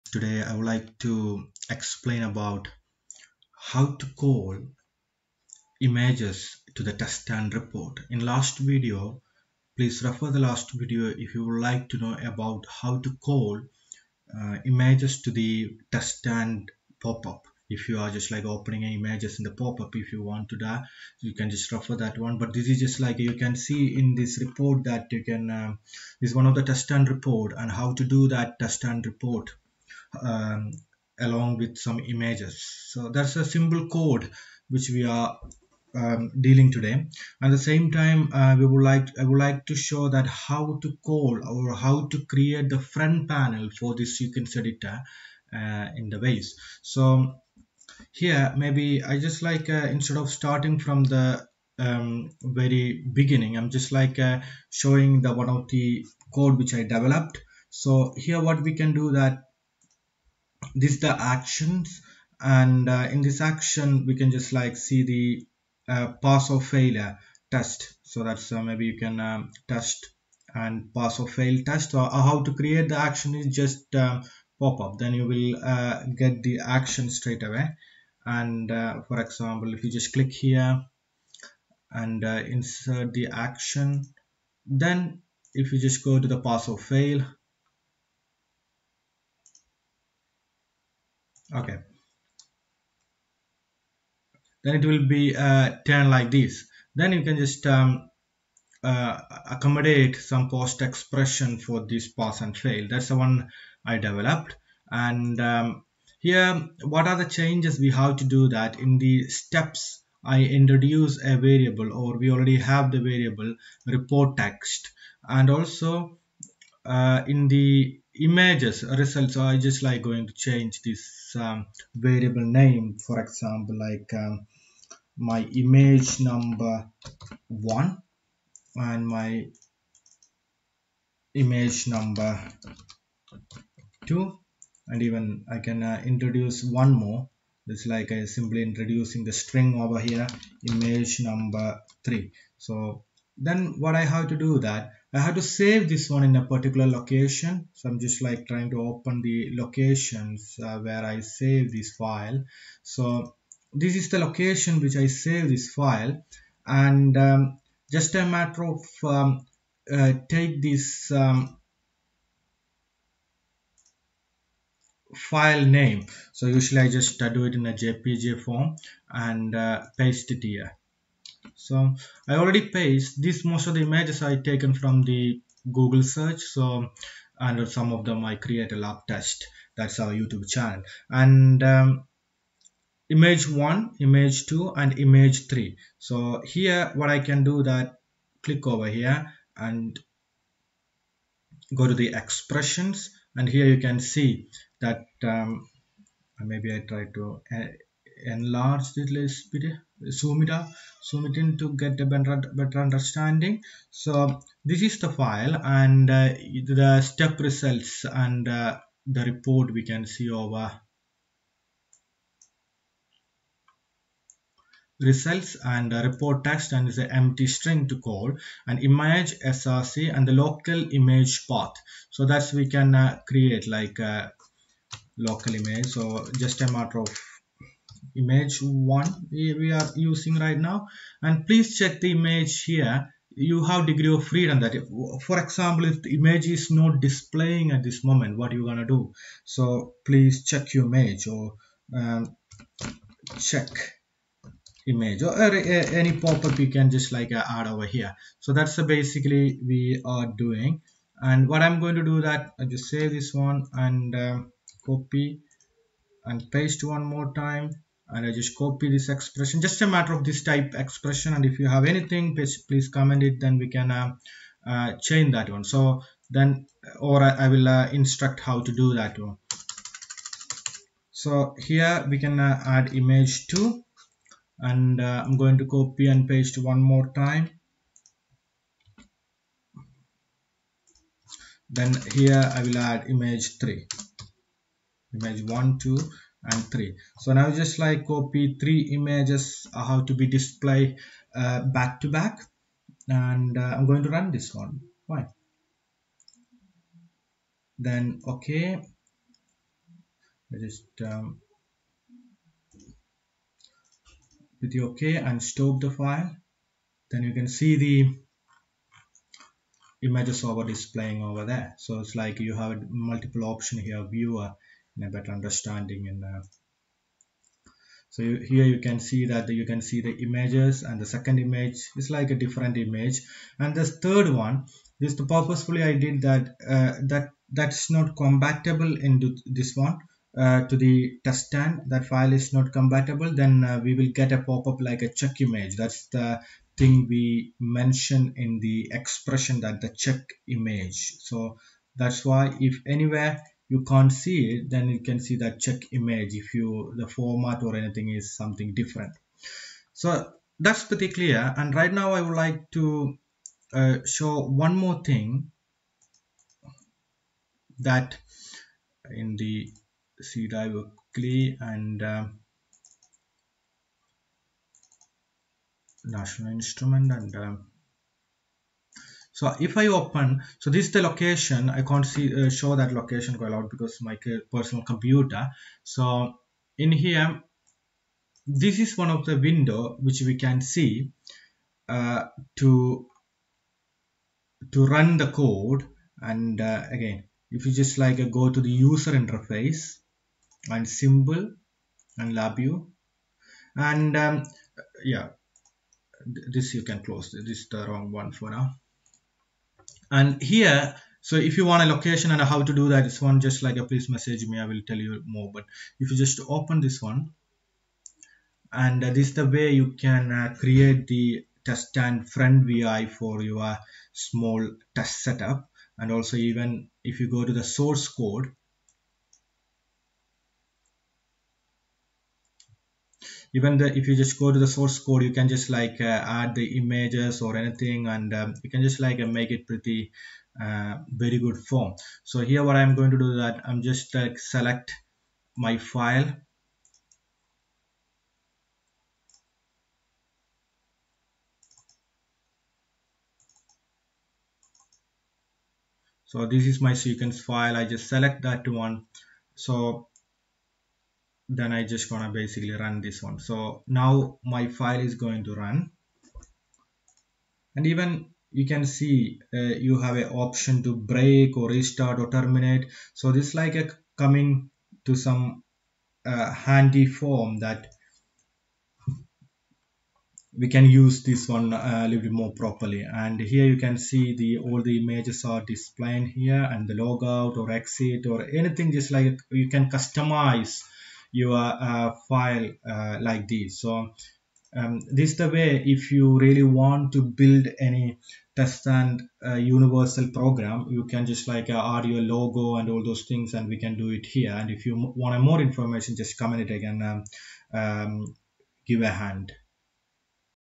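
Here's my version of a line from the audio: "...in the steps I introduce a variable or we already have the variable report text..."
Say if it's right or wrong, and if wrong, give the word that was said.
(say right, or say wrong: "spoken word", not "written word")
right.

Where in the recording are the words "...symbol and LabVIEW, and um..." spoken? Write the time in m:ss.
6:30.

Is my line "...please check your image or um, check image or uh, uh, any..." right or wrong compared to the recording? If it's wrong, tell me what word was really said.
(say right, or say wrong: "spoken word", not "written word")
right.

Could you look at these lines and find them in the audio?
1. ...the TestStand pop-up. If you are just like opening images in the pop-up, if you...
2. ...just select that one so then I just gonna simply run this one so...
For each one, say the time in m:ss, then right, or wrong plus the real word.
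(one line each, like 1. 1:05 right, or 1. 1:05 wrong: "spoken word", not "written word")
1. 0:15 right
2. 7:27 wrong: "basically", not "simply".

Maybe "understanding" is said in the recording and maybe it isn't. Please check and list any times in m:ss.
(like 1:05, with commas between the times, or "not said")
3:22, 5:15.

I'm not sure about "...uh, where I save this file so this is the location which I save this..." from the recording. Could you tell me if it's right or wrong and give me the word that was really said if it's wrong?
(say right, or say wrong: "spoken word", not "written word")
right.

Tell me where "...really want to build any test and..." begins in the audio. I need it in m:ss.
8:06.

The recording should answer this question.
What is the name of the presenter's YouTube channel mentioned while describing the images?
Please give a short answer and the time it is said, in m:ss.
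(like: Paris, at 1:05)
Lab Test, at 2:58.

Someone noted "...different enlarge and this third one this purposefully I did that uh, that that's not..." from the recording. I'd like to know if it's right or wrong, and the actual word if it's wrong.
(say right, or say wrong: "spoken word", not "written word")
wrong: "image", not "enlarge".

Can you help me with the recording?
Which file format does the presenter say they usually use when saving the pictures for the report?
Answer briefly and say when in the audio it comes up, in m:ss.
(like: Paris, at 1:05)
JPG, at 2:47.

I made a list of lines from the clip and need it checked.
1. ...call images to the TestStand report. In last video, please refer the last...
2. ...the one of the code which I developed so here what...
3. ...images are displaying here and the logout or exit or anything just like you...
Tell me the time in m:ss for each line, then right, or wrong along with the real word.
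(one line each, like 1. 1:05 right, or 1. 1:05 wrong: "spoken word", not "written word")
1. 0:04 right
2. 0:55 right
3. 7:55 right.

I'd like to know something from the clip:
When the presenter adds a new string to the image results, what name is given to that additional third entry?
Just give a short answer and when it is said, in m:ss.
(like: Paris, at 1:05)
image number three, at 2:20.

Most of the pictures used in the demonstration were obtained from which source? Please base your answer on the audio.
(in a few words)
Google search.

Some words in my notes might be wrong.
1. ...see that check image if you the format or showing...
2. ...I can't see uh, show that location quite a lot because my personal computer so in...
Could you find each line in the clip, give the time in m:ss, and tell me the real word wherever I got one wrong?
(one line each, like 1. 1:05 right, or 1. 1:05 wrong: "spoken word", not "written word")
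1. 5:45 wrong: "anything", not "showing"
2. 6:11 right.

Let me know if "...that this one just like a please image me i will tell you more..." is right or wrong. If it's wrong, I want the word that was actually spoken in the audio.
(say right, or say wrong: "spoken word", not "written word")
wrong: "message", not "image".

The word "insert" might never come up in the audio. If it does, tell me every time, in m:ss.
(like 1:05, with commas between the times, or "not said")
1:22.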